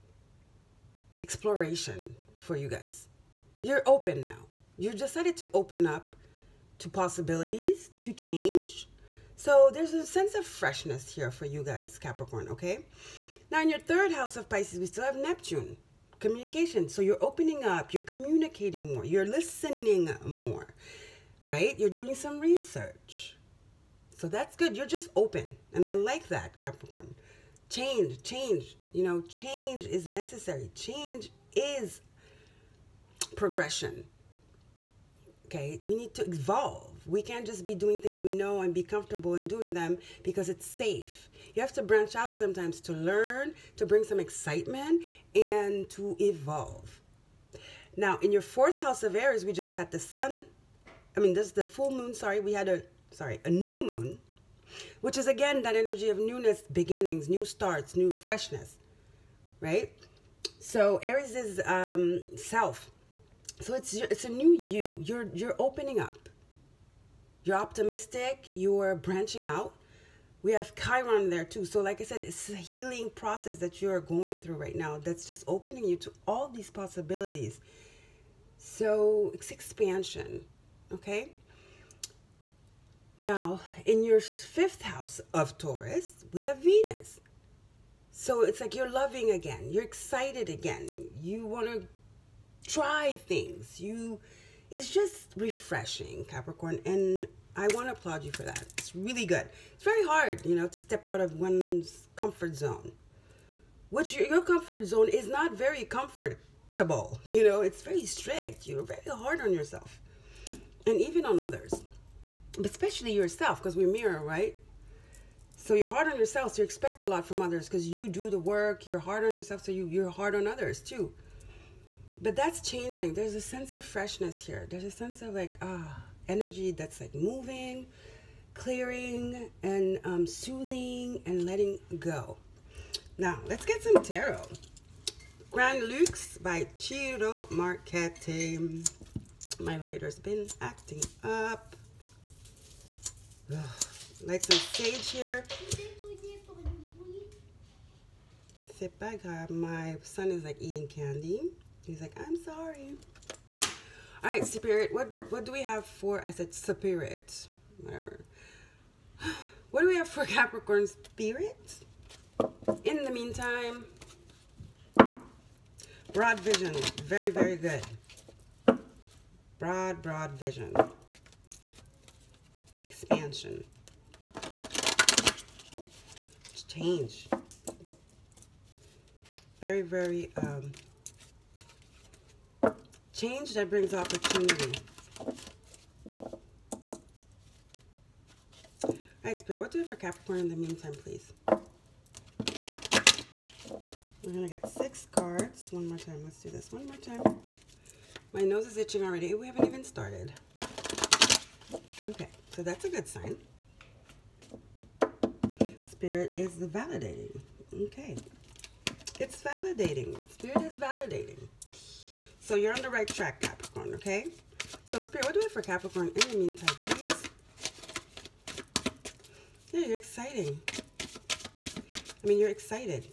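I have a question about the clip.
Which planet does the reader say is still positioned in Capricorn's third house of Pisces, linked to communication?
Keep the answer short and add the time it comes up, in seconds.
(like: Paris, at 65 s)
Neptune, at 15 s.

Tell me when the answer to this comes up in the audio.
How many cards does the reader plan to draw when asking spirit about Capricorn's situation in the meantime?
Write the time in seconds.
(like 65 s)
194 s.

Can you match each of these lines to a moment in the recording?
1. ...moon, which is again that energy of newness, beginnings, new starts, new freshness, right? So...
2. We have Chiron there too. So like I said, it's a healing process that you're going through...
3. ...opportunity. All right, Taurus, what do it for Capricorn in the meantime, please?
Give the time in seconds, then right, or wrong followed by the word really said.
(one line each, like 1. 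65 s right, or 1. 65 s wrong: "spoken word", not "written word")
1. 53 s right
2. 70 s right
3. 183 s wrong: "Spirit", not "Taurus".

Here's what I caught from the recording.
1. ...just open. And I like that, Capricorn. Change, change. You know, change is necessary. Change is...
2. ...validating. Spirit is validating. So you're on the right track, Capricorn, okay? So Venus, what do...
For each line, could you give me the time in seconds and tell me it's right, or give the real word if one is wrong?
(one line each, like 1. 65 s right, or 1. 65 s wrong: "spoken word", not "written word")
1. 24 s right
2. 209 s wrong: "Spirit", not "Venus".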